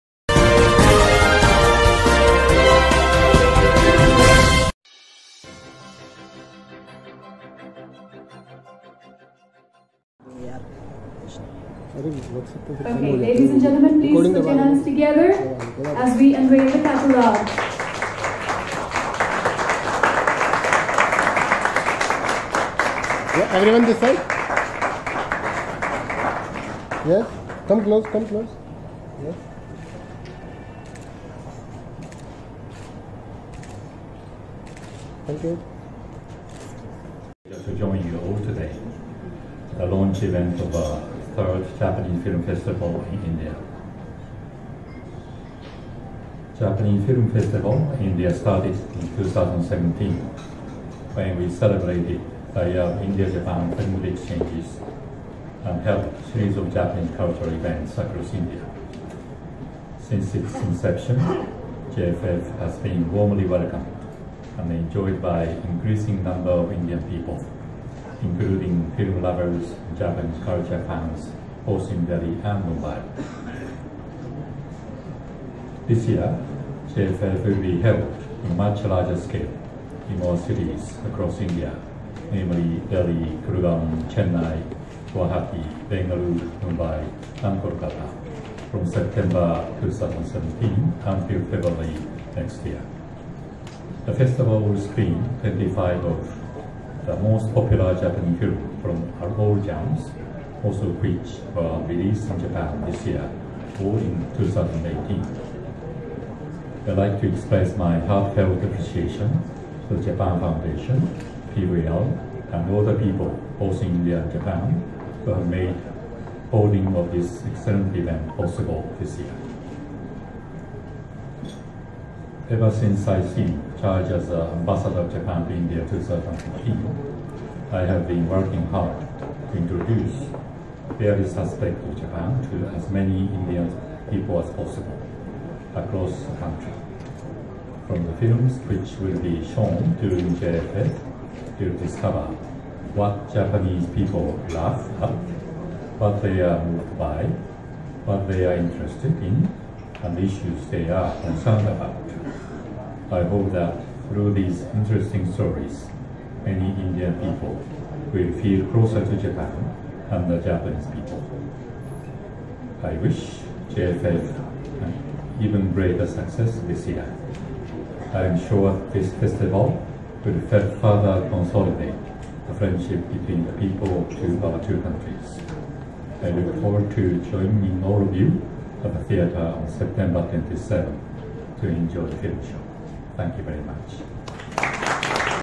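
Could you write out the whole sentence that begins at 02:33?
I hope that through these interesting stories, many Indian people will feel closer to Japan and the Japanese people.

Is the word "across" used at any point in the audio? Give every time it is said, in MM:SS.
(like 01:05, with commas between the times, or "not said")
00:57, 01:21, 02:15.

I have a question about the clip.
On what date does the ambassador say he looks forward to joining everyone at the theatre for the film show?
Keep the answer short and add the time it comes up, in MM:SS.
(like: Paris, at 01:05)
September 27, at 02:59.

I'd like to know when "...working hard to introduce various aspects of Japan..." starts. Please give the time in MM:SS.
02:08.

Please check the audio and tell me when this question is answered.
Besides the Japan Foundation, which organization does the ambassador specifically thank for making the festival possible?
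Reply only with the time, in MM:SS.
01:51.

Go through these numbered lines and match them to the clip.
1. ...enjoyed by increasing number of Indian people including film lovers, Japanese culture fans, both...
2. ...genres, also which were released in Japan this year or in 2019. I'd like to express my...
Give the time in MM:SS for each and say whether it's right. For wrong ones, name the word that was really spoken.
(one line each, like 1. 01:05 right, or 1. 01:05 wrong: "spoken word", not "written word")
1. 01:04 right
2. 01:39 wrong: "2018", not "2019".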